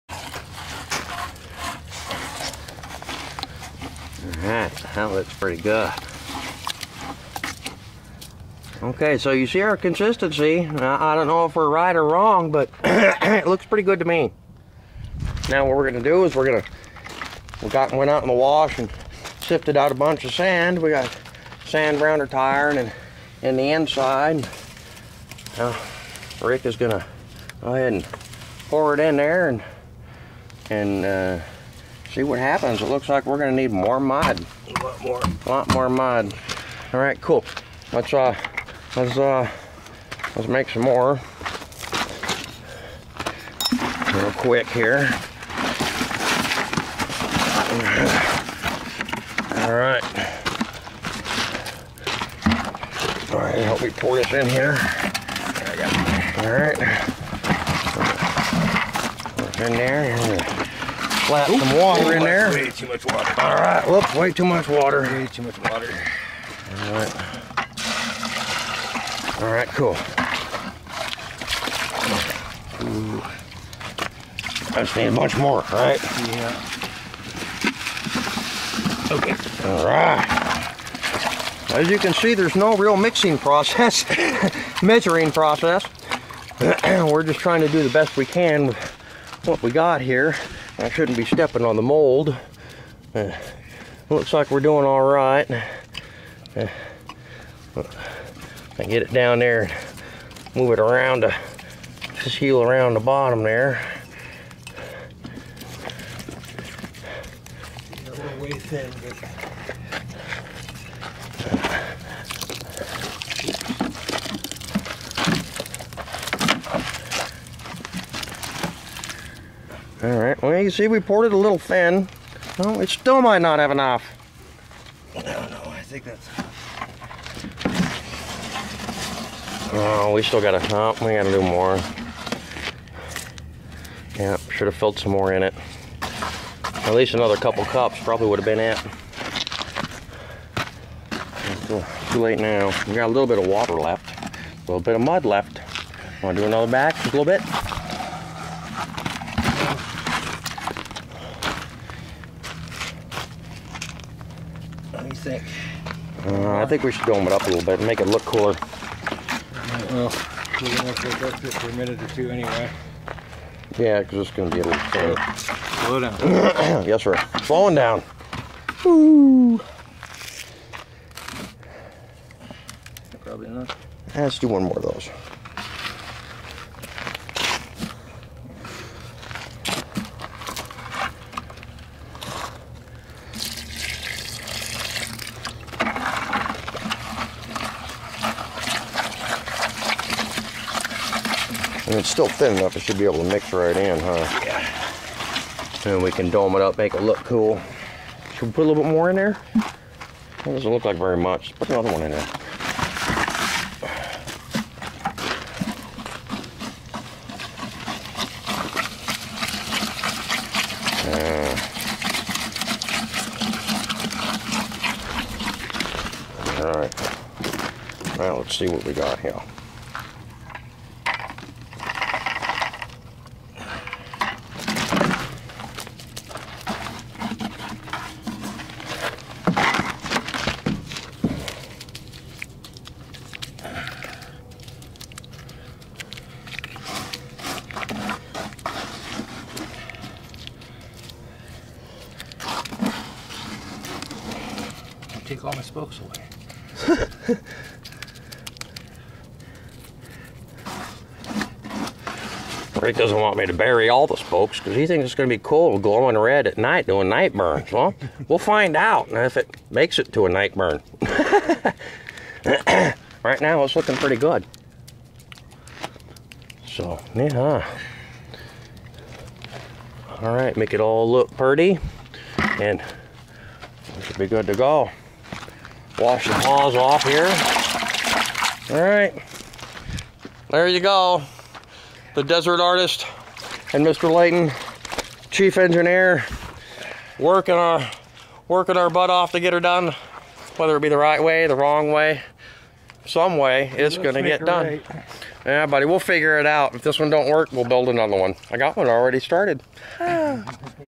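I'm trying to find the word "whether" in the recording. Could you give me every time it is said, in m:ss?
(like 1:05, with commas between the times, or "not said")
4:50.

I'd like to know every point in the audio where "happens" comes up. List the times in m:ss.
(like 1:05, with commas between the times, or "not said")
0:32.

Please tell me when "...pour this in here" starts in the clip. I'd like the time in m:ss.
0:53.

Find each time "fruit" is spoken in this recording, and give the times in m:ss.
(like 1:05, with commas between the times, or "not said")
not said.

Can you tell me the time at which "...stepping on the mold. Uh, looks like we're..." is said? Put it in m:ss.
1:31.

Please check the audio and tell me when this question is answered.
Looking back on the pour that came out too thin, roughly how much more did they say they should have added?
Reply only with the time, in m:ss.
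2:17.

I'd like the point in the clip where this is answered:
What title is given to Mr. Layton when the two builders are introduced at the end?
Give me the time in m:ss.
4:45.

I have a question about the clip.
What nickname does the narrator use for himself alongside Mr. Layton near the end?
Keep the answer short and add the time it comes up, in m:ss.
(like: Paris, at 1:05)
The Desert Artist, at 4:42.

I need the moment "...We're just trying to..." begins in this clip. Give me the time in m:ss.
1:26.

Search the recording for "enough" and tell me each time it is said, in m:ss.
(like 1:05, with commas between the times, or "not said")
2:03, 3:12.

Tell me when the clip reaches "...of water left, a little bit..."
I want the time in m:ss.
2:23.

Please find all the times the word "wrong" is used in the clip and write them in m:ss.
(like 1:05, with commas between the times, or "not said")
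0:12, 4:51.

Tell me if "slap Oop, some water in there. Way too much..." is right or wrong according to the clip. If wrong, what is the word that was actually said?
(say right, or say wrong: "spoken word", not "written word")
right.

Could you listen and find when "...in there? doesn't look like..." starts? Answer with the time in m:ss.
3:19.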